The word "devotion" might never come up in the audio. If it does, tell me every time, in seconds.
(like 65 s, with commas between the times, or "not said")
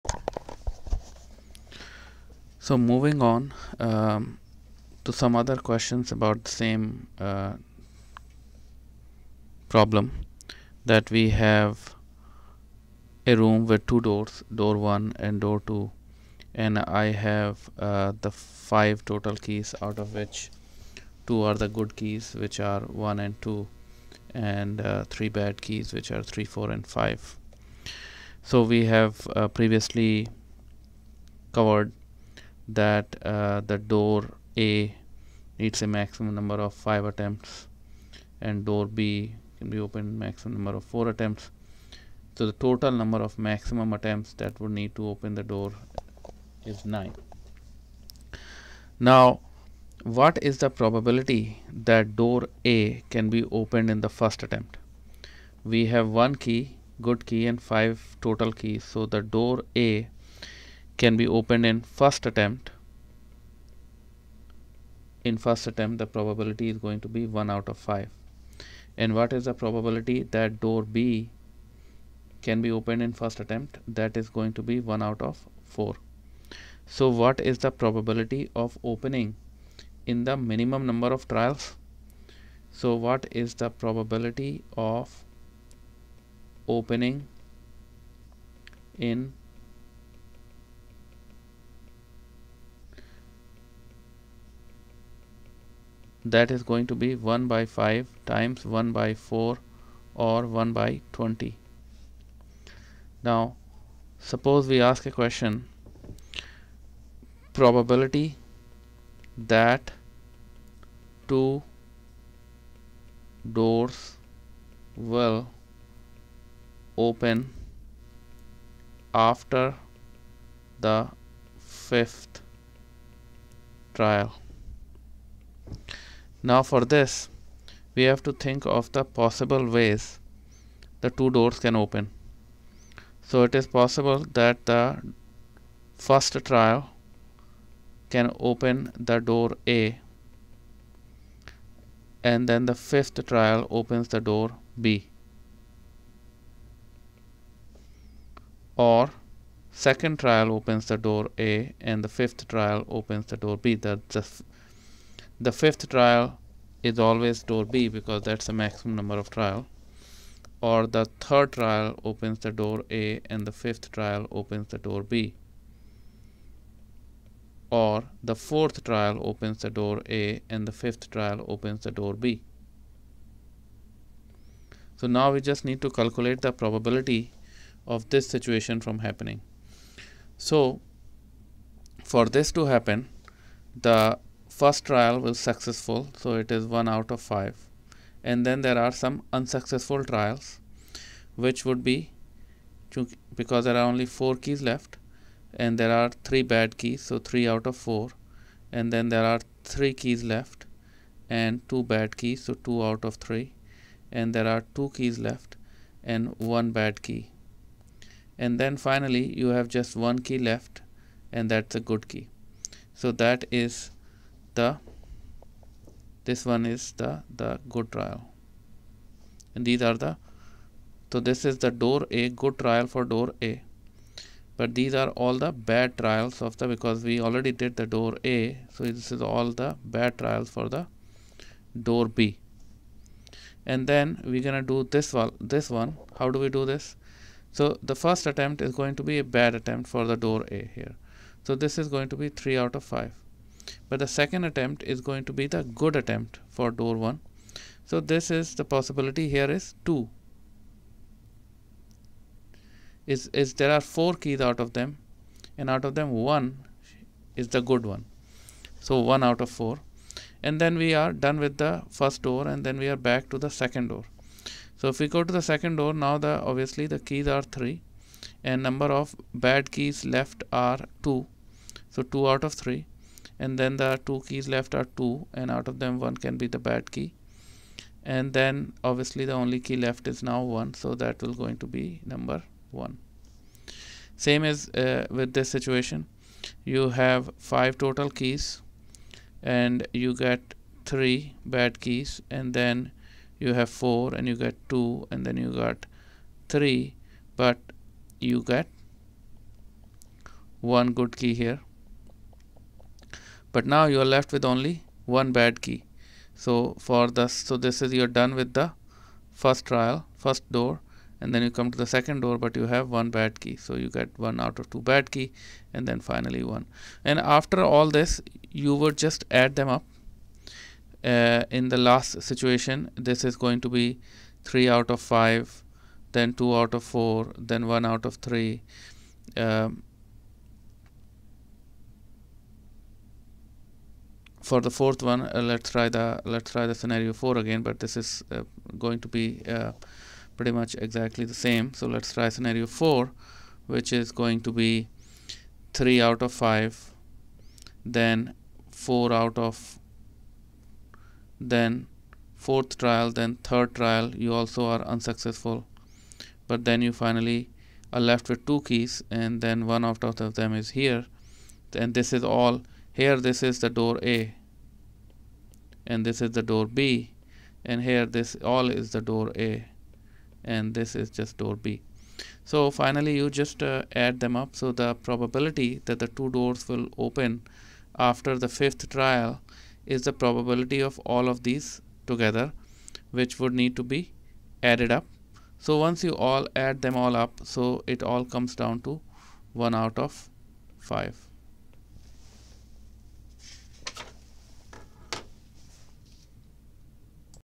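not said.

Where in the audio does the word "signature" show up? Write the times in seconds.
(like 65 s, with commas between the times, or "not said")
not said.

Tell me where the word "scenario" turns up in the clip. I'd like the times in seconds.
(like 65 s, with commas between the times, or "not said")
336 s, 342 s.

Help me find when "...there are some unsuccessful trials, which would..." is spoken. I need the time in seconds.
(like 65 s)
188 s.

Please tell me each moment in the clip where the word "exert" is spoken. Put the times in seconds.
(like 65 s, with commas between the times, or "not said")
not said.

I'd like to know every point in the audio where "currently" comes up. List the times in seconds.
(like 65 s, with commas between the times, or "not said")
not said.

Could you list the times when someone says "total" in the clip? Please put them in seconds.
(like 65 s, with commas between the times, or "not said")
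19 s, 42 s, 58 s, 287 s.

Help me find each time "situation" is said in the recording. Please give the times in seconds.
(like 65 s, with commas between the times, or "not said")
178 s, 285 s, 322 s.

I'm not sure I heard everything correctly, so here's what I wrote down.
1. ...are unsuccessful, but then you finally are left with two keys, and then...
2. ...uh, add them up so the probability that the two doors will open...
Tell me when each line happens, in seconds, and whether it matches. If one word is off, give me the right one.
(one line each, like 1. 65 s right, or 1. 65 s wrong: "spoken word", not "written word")
1. 354 s right
2. 373 s right.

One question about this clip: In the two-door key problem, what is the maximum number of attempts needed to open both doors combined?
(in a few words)
9.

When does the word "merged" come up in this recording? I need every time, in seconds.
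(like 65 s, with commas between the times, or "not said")
not said.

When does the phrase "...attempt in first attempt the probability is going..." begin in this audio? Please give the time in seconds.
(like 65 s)
62 s.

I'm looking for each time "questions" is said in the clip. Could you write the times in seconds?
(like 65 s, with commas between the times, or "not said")
5 s, 105 s.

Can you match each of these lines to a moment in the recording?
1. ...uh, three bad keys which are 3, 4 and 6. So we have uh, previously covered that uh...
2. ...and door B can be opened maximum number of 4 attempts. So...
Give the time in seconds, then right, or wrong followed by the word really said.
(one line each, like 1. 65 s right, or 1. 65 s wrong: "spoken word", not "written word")
1. 24 s wrong: "5", not "6"
2. 38 s right.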